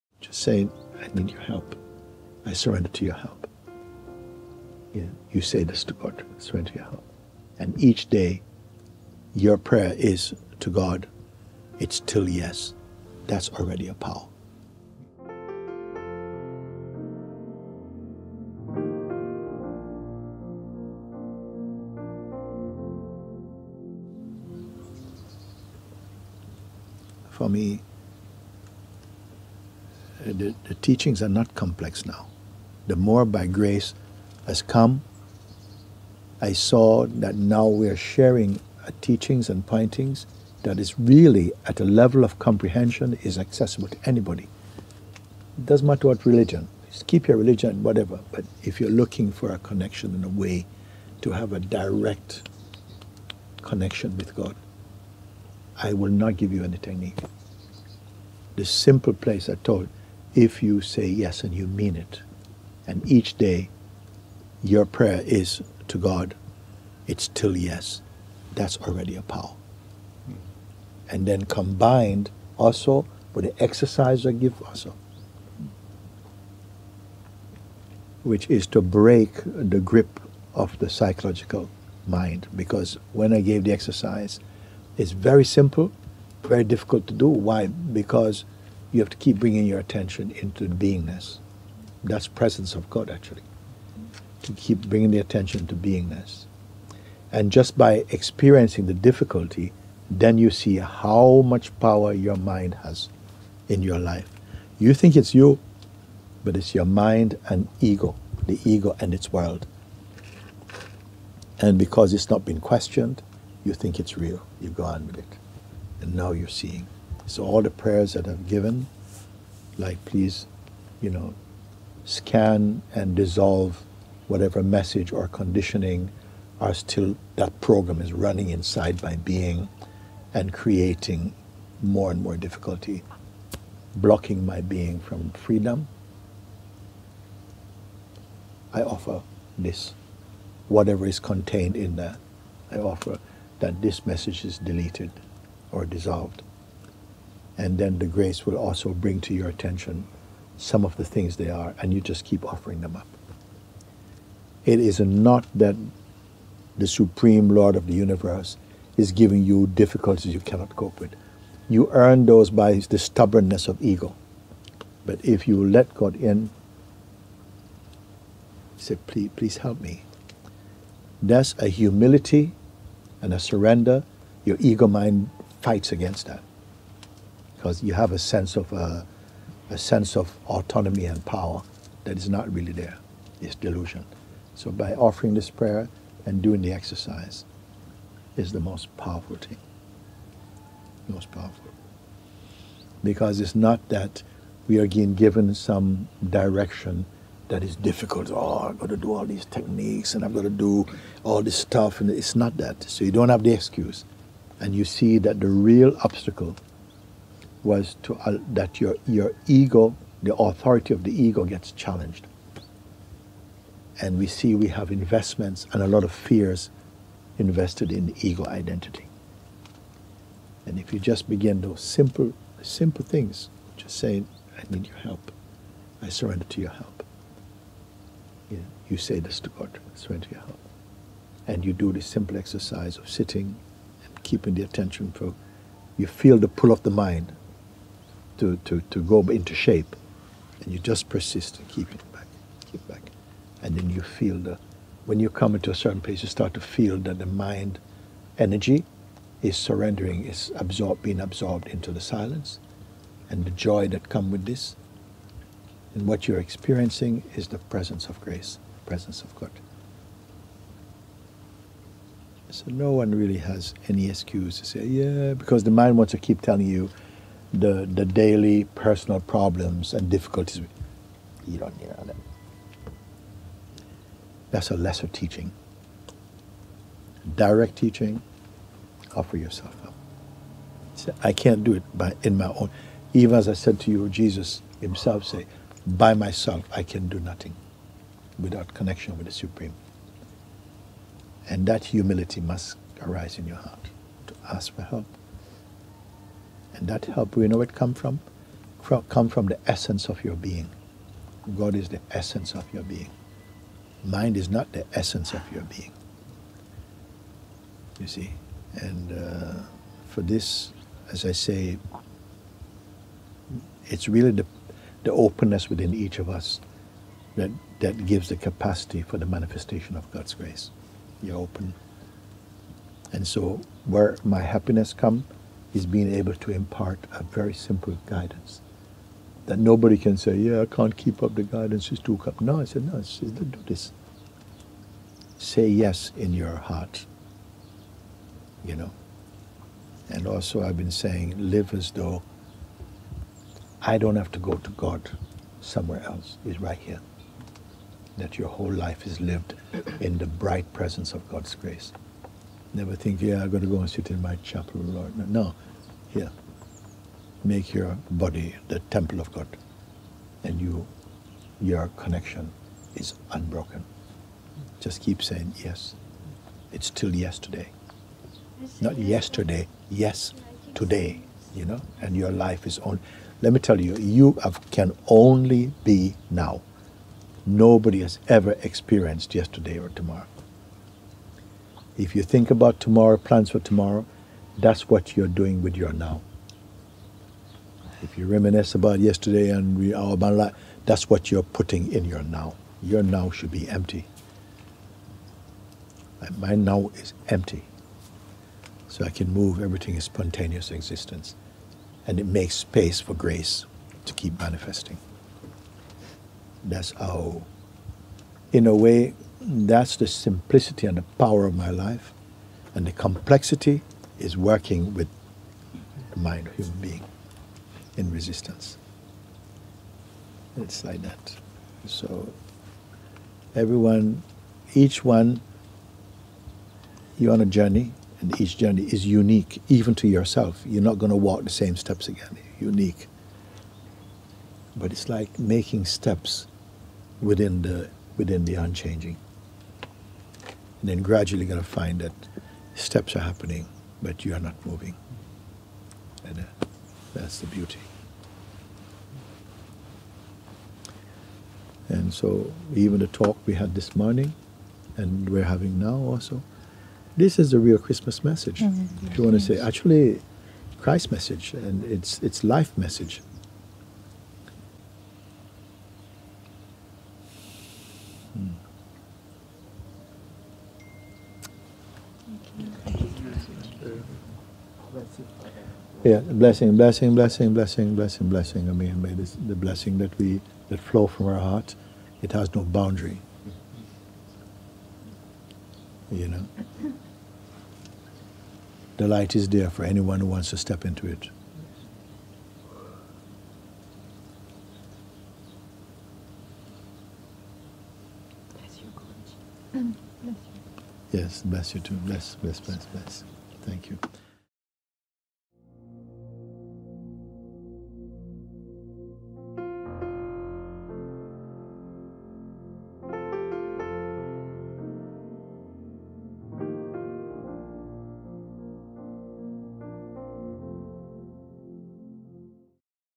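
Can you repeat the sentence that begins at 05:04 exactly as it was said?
Mind is not the essence of your being.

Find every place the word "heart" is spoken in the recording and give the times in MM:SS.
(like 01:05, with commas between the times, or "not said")
04:53, 05:36, 08:01.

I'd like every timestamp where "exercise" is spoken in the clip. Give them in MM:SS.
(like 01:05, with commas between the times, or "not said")
01:13, 01:23, 03:06, 03:52.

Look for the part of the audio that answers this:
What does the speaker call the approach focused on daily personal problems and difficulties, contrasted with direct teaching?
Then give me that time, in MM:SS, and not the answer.
04:34.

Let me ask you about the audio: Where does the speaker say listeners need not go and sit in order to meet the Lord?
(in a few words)
My chapel.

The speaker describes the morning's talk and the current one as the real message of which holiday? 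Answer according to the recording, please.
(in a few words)
Christmas.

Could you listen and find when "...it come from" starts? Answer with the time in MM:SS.
04:57.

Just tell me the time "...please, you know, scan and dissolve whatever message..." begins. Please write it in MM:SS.
02:00.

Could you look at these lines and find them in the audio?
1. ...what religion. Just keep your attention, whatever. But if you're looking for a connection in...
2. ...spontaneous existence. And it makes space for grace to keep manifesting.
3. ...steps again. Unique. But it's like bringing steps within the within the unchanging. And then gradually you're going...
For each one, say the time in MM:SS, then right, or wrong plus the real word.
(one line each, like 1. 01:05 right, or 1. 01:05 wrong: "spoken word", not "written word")
1. 00:46 wrong: "religion", not "attention"
2. 06:40 right
3. 07:11 wrong: "making", not "bringing".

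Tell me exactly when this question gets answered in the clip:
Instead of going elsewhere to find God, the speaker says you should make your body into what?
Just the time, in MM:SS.
05:58.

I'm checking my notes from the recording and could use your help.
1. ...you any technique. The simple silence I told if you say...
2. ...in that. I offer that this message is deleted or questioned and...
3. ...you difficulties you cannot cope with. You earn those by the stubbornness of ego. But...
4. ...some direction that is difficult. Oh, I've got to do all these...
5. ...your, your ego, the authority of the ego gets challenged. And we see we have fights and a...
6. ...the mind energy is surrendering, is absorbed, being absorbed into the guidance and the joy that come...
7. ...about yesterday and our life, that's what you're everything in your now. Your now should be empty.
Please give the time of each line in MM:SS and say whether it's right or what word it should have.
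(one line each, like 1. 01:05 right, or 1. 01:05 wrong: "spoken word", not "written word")
1. 00:56 wrong: "place", not "silence"
2. 02:21 wrong: "dissolved", not "questioned"
3. 02:39 right
4. 03:15 right
5. 03:28 wrong: "investments", not "fights"
6. 04:07 wrong: "silence", not "guidance"
7. 06:28 wrong: "putting", not "everything".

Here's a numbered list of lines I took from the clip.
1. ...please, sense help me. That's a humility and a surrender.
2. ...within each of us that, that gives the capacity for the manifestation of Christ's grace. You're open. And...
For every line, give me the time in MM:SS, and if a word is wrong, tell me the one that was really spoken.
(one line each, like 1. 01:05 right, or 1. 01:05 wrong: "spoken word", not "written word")
1. 02:49 wrong: "please", not "sense"
2. 05:15 wrong: "God", not "Christ".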